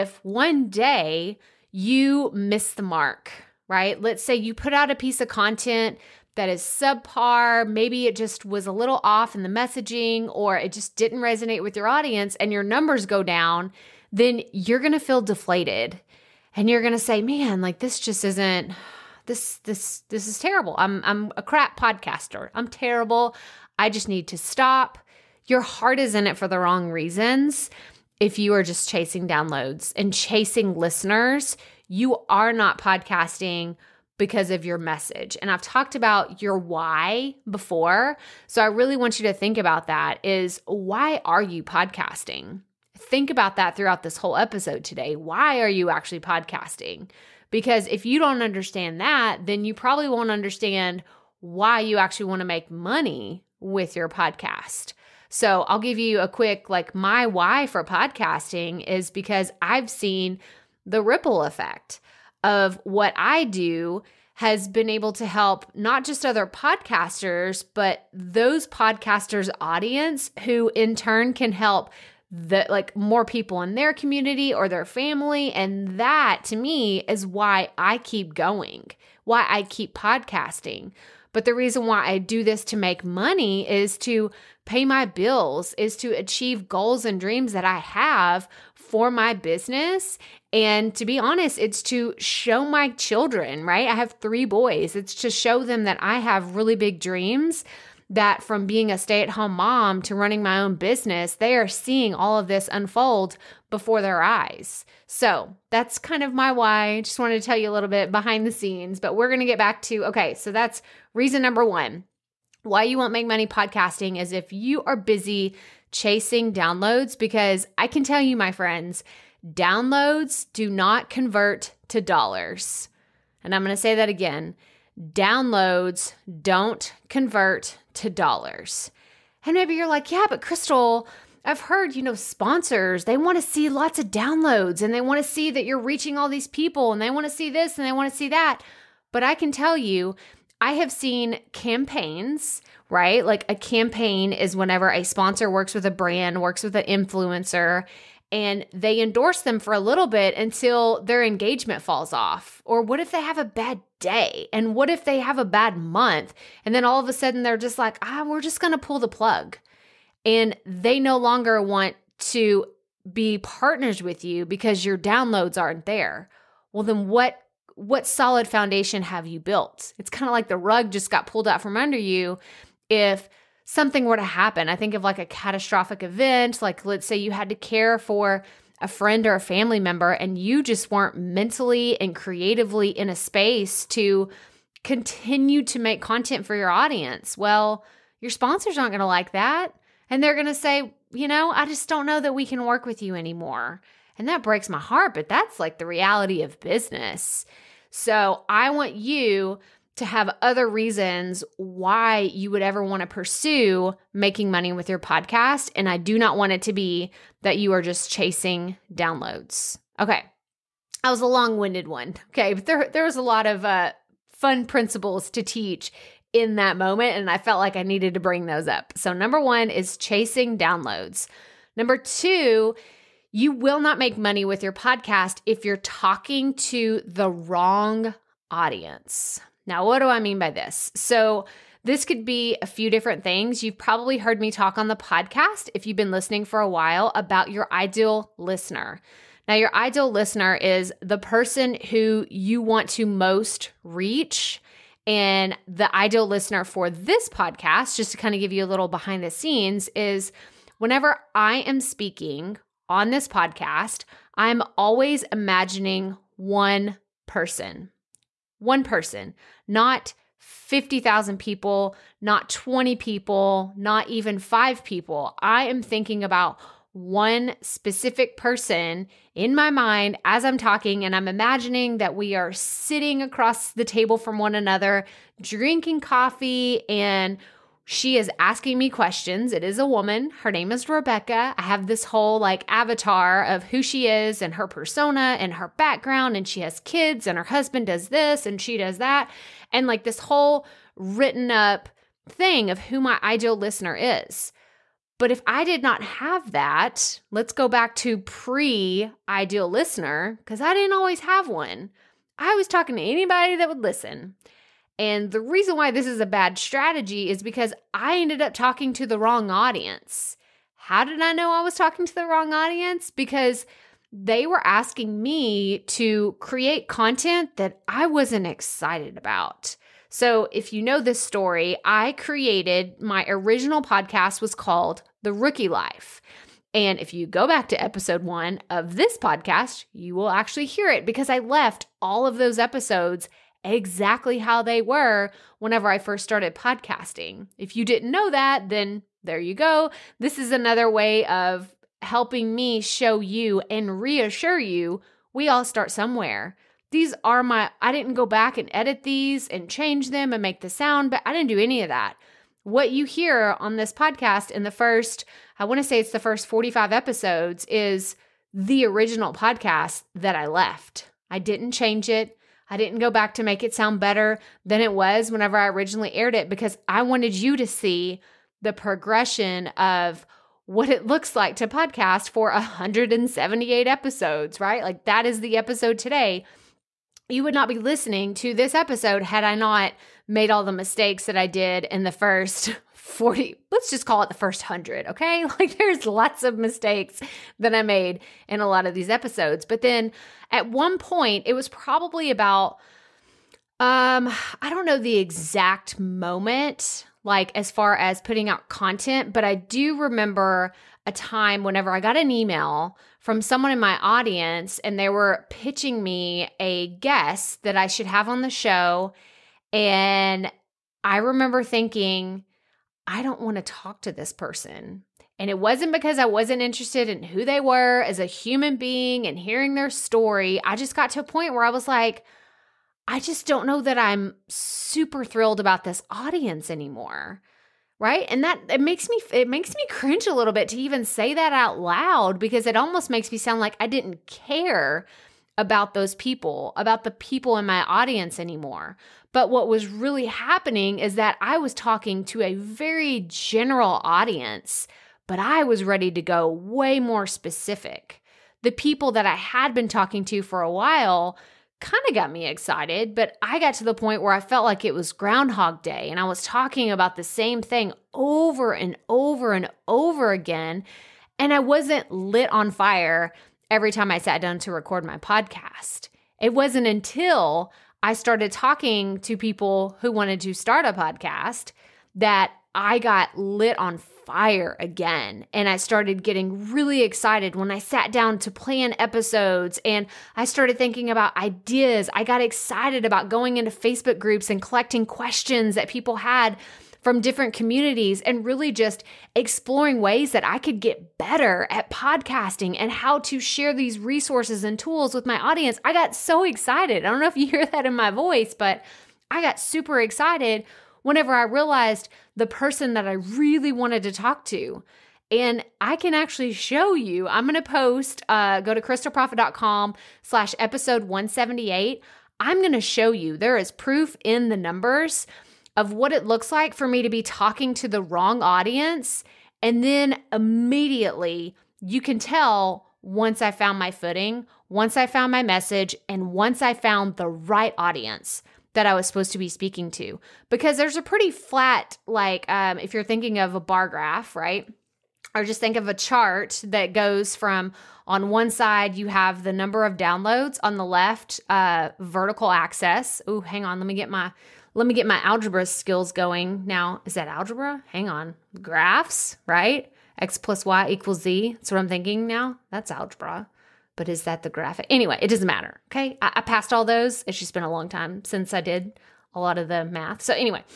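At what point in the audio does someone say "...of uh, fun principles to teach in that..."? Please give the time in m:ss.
3:33.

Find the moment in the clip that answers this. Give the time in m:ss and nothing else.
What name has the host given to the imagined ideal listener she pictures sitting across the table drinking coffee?
4:40.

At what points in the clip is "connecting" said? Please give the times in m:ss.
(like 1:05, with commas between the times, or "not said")
not said.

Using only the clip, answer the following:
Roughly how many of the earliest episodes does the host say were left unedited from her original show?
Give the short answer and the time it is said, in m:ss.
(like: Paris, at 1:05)
45, at 5:56.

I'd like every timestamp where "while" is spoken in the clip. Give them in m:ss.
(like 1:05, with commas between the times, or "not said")
3:56, 7:30.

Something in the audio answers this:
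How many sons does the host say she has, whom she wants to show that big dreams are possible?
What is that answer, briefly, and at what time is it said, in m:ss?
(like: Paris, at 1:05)
3, at 1:34.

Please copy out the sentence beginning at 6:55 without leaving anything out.
And it wasn't because I wasn't interested in who they were as a human being and hearing their story.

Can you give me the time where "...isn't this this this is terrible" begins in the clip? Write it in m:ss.
0:18.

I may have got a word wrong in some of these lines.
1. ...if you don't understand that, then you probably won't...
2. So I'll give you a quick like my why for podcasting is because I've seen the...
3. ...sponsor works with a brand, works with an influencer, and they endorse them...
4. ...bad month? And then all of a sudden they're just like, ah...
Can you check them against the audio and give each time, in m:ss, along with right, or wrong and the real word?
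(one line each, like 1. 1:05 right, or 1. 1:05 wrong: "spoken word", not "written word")
1. 0:47 right
2. 0:55 right
3. 2:25 right
4. 2:35 right.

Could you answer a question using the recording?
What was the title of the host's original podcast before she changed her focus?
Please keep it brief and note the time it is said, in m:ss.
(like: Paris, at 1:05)
The Rookie Life, at 5:25.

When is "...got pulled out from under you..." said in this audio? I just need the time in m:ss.
2:51.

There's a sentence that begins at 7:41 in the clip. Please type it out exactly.
And I wasn't lit on fire every time I sat down to record my podcast.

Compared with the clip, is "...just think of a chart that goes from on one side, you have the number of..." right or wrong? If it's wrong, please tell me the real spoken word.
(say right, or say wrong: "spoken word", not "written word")
right.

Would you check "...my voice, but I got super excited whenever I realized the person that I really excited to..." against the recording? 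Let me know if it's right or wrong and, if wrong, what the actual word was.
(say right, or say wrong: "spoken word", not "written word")
wrong: "wanted", not "excited".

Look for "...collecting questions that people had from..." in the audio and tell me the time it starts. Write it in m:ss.
8:04.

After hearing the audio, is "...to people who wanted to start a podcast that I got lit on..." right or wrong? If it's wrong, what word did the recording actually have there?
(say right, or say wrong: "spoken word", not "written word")
right.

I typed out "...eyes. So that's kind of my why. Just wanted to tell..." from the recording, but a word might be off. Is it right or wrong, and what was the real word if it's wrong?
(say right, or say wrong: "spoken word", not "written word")
right.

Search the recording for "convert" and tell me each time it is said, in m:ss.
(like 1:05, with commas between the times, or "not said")
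2:01, 2:07.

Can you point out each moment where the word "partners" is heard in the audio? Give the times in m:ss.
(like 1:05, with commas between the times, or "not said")
2:43.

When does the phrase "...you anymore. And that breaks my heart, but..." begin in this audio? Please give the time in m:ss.
3:13.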